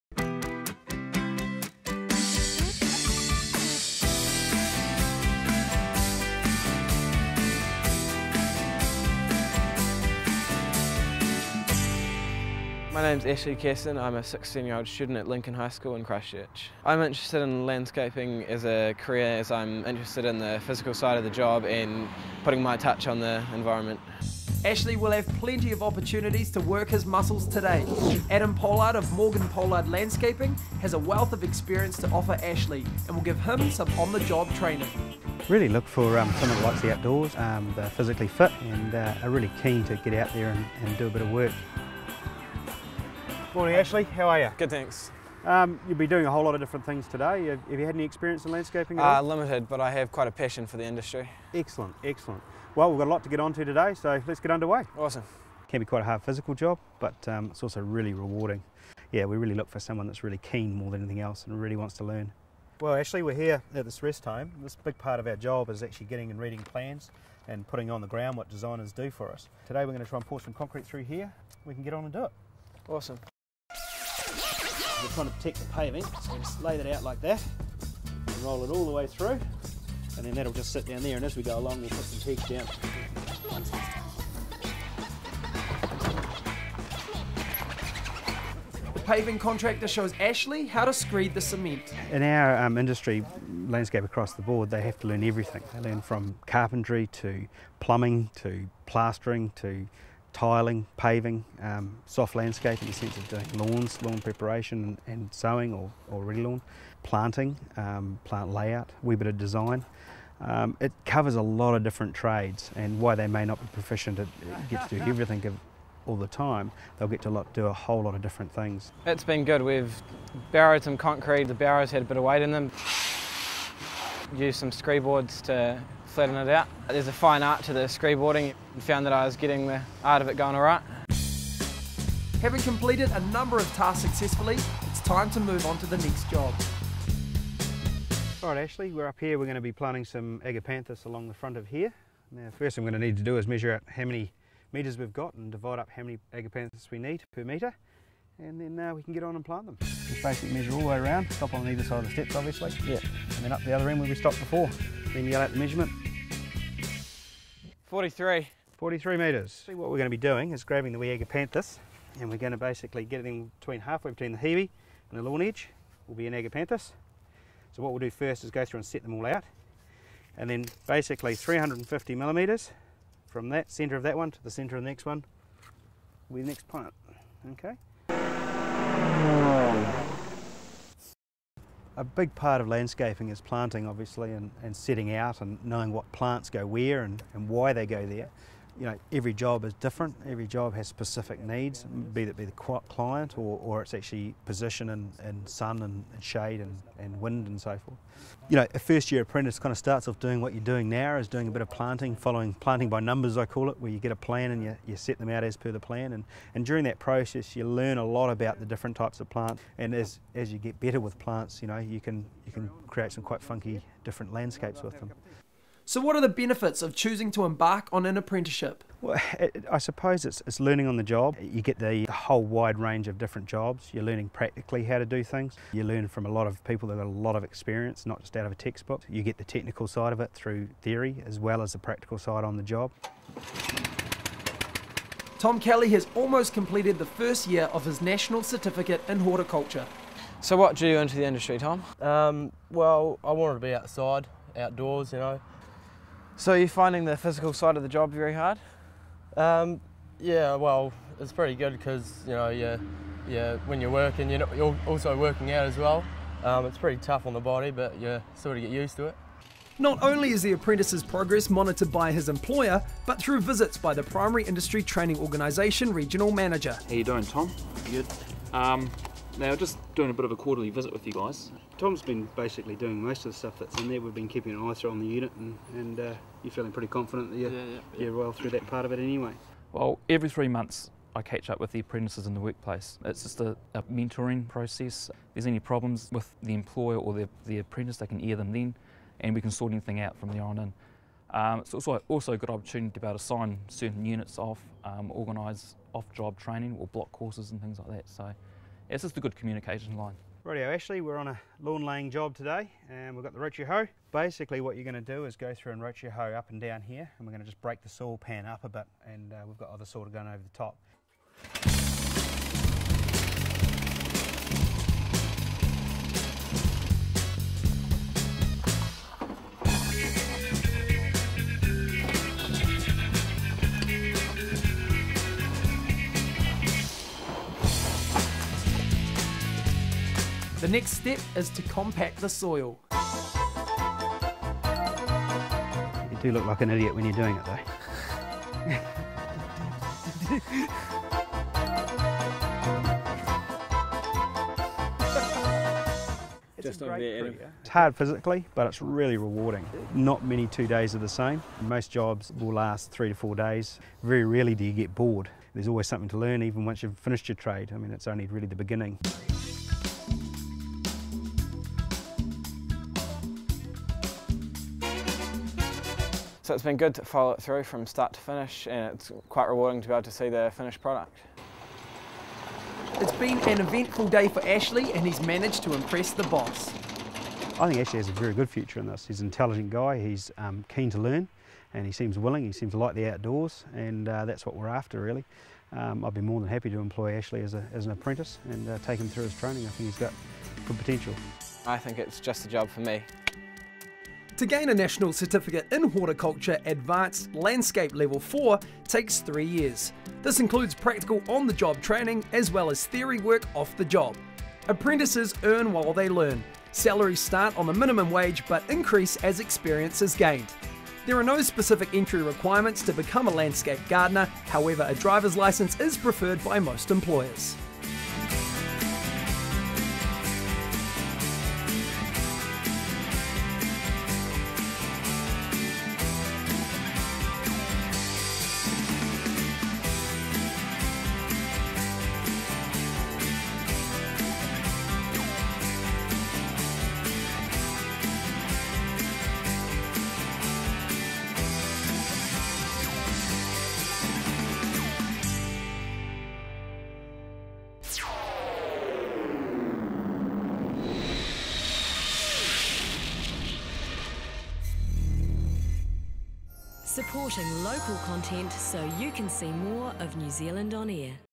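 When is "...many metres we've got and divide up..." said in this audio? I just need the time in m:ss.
2:24.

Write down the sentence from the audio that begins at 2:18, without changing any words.
All right, Ashley, we're up here.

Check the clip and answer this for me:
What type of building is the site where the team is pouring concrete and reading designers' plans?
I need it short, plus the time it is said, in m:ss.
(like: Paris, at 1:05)
Rest home, at 1:04.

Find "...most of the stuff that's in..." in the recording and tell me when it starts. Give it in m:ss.
4:33.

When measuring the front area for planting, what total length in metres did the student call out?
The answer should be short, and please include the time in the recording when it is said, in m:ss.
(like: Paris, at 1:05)
43 metres, at 2:38.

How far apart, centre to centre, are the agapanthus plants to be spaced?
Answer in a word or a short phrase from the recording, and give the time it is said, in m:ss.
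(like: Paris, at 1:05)
350 millimetres, at 2:51.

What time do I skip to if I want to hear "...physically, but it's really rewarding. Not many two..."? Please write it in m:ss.
5:47.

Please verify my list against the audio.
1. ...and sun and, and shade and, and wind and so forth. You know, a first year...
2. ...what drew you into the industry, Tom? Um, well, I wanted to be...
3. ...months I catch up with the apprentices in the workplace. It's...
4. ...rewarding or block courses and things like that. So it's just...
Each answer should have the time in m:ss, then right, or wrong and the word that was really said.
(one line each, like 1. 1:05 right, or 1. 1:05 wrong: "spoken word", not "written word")
1. 3:15 right
2. 4:00 right
3. 4:40 right
4. 4:56 wrong: "training", not "rewarding".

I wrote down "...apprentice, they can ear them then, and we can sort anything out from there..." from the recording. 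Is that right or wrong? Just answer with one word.
right.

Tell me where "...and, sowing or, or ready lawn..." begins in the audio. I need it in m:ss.
1:45.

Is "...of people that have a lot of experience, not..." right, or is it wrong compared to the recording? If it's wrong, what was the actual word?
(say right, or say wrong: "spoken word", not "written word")
right.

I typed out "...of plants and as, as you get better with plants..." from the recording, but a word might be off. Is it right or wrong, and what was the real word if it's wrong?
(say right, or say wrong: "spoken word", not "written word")
right.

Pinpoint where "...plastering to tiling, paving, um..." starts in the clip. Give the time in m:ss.
1:38.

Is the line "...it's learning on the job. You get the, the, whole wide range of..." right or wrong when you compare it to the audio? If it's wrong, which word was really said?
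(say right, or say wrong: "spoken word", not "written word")
right.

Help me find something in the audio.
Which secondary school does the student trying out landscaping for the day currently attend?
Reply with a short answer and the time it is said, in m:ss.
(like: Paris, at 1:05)
Lincoln High School, at 0:15.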